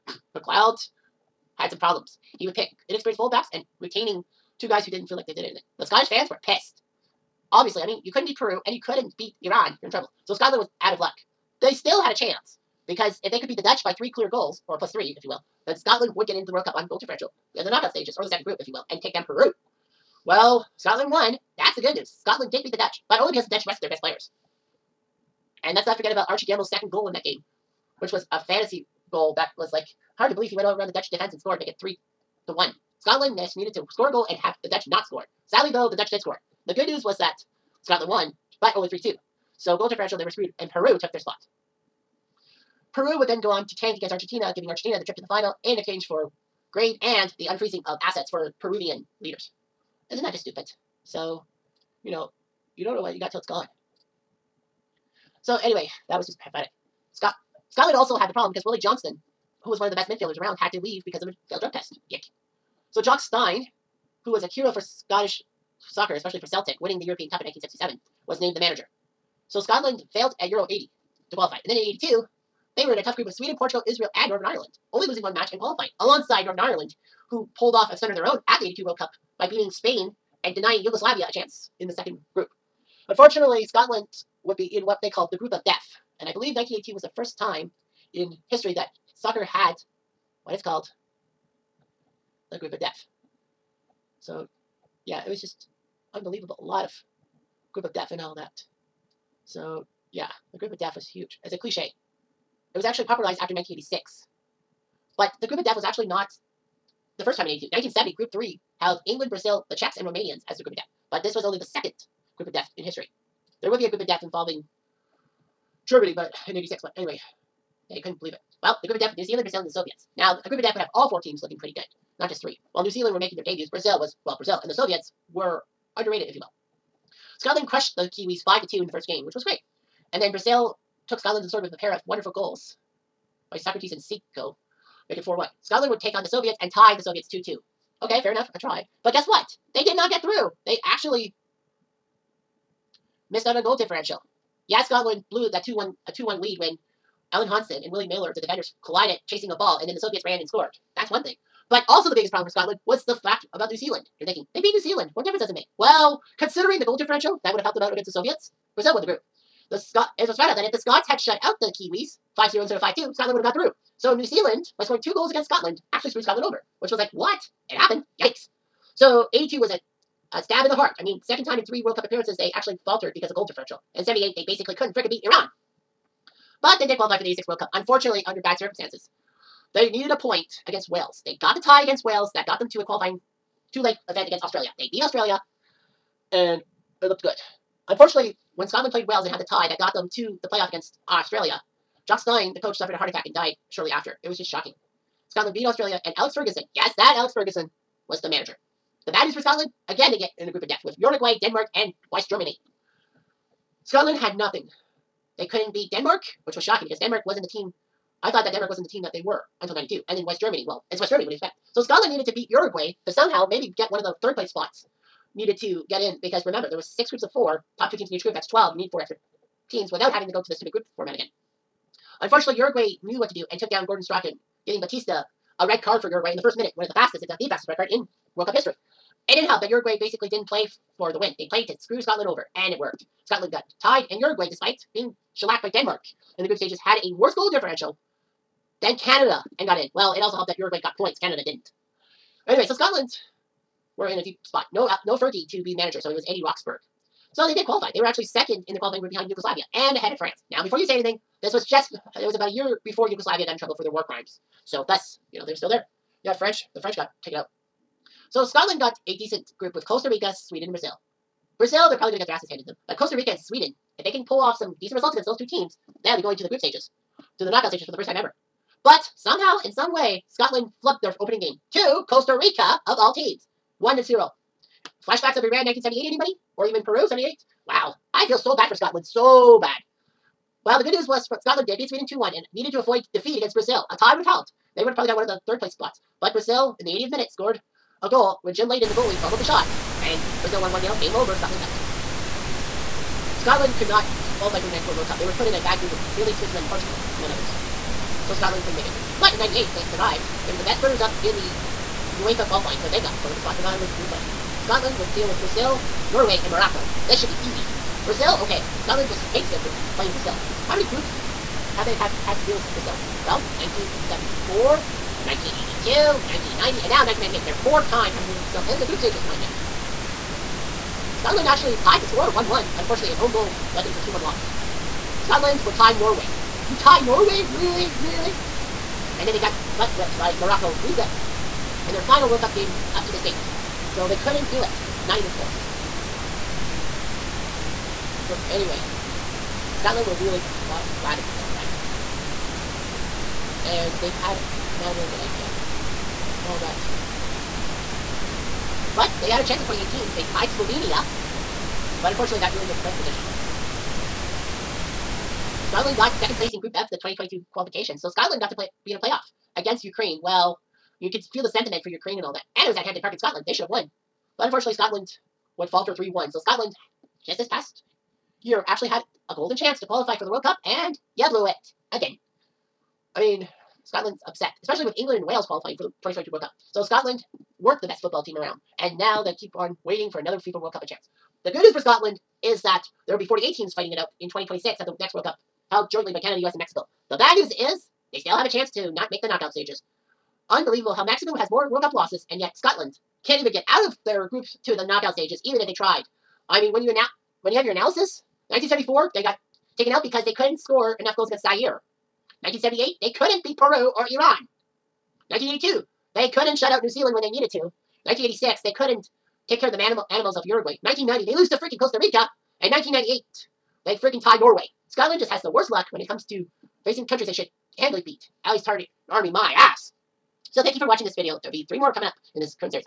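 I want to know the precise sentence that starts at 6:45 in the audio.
1982, they couldn't shut out New Zealand when they needed to.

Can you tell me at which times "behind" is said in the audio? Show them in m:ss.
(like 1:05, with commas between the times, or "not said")
4:09.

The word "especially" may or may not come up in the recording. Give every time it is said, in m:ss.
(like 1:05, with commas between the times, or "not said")
1:06, 6:14.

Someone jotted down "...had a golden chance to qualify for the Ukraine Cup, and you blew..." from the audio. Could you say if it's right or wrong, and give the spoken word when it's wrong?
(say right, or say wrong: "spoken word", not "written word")
wrong: "World", not "Ukraine".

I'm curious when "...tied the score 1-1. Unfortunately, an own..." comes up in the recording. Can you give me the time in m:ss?
5:21.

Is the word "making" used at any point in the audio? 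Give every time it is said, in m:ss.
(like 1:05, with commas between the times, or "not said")
2:03, 2:15.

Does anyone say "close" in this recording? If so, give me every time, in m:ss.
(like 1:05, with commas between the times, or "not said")
5:35.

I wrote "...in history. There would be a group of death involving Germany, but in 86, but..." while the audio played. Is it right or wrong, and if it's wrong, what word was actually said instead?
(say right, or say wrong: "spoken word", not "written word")
right.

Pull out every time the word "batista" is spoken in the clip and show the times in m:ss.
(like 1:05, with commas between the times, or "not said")
3:44.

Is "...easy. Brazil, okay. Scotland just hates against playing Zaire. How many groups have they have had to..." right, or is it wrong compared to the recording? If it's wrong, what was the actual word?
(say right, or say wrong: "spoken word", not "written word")
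wrong: "Brazil", not "Zaire".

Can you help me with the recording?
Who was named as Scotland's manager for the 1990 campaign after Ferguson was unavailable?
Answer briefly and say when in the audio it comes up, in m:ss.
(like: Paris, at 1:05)
Eddie Roxburgh, at 4:06.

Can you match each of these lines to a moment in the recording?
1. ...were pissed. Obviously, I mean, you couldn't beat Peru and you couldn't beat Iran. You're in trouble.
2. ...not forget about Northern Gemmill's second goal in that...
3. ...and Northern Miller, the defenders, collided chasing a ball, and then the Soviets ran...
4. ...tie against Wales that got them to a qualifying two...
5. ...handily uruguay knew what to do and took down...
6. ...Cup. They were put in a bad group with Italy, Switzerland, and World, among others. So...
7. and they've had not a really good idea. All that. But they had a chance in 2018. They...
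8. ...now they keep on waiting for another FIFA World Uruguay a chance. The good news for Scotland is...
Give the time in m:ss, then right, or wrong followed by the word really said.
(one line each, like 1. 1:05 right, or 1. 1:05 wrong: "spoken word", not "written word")
1. 0:06 right
2. 0:25 wrong: "Archie", not "Northern"
3. 2:27 wrong: "Willie", not "Northern"
4. 3:01 right
5. 3:42 wrong: "unfortunately", not "handily"
6. 4:55 wrong: "Portugal", not "World"
7. 5:43 right
8. 6:18 wrong: "Cup", not "Uruguay".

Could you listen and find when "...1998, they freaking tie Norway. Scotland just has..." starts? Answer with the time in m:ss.
6:52.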